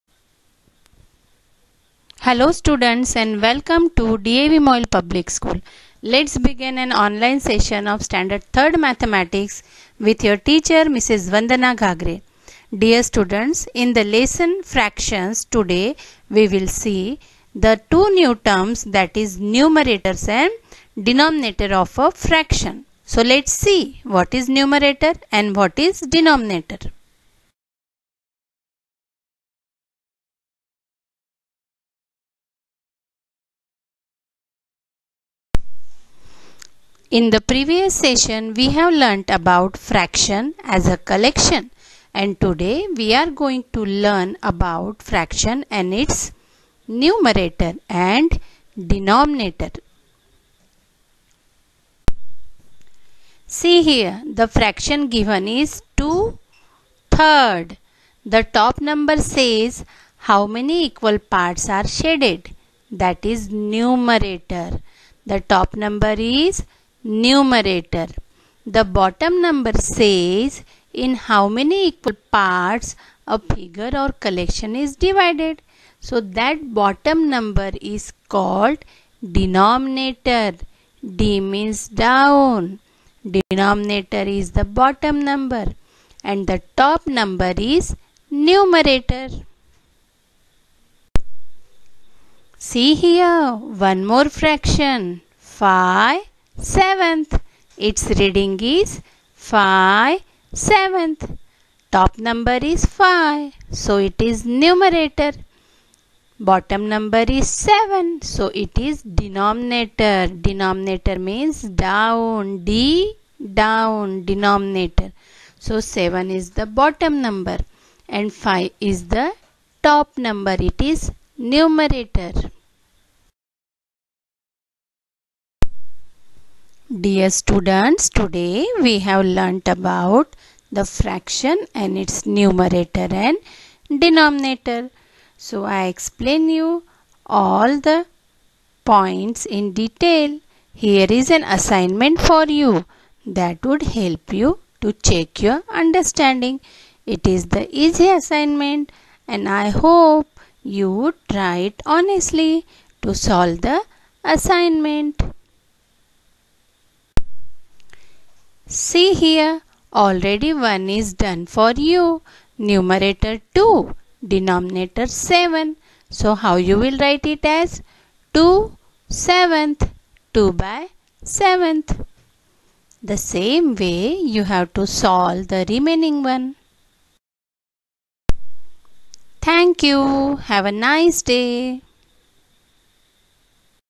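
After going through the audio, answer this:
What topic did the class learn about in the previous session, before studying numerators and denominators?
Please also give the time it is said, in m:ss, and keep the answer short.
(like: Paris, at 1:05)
fraction as a collection, at 0:39.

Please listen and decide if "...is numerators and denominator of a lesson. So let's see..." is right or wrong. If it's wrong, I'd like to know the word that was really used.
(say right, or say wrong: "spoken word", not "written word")
wrong: "fraction", not "lesson".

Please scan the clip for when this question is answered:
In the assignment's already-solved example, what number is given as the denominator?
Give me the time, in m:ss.
2:44.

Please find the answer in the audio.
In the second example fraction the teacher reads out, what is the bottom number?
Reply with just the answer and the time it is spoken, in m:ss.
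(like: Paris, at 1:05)
7, at 1:46.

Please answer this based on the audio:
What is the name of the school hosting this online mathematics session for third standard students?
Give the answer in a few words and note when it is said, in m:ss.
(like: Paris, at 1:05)
DAV MOIL Public School, at 0:04.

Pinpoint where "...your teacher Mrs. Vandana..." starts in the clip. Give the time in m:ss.
0:10.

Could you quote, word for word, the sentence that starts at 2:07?
Dear students, today we have learnt about the fraction and its numerator and denominator.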